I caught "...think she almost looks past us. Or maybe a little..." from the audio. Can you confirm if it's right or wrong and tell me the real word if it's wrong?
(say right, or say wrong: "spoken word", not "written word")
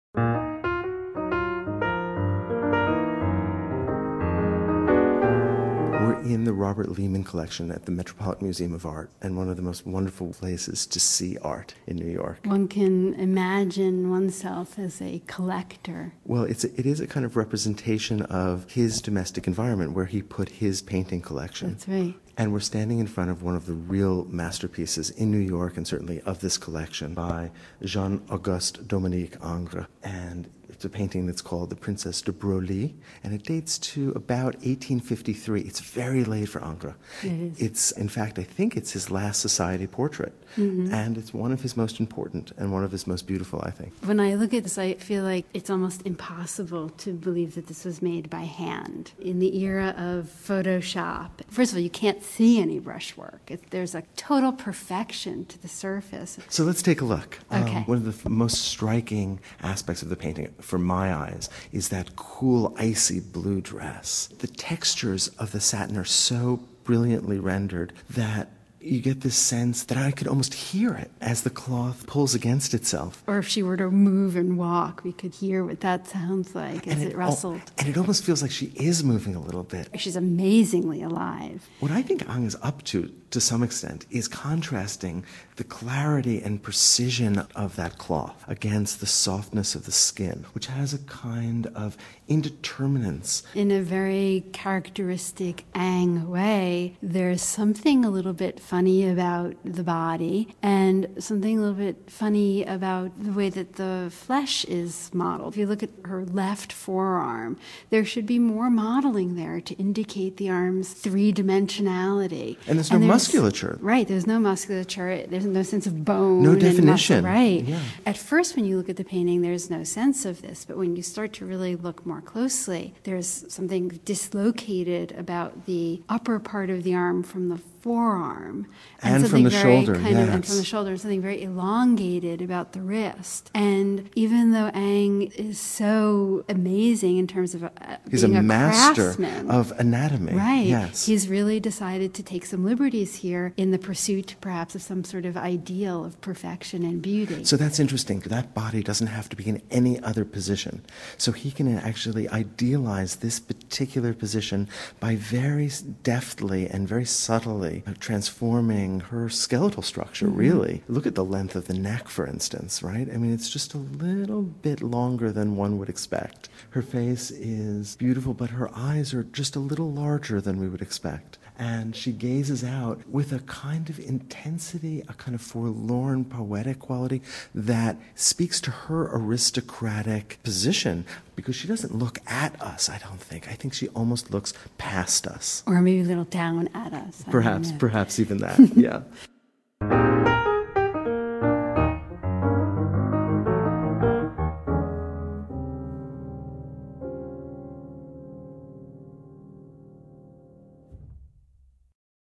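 right.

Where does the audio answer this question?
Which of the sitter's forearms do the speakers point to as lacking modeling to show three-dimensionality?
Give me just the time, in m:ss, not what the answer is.
1:46.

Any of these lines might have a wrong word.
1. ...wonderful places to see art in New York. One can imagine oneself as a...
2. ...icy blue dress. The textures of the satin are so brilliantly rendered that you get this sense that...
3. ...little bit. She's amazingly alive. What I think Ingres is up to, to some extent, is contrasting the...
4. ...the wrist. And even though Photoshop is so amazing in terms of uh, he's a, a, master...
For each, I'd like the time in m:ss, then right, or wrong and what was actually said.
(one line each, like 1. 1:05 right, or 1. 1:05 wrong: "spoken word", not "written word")
1. 0:09 right
2. 1:02 right
3. 1:19 right
4. 2:12 wrong: "Ingres", not "Photoshop".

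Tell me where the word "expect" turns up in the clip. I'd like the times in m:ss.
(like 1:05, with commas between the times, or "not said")
2:45, 2:50.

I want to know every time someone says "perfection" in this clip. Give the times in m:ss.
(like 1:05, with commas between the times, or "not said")
0:54, 2:26.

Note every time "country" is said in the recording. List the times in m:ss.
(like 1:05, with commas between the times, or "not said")
not said.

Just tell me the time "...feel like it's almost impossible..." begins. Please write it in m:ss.
0:44.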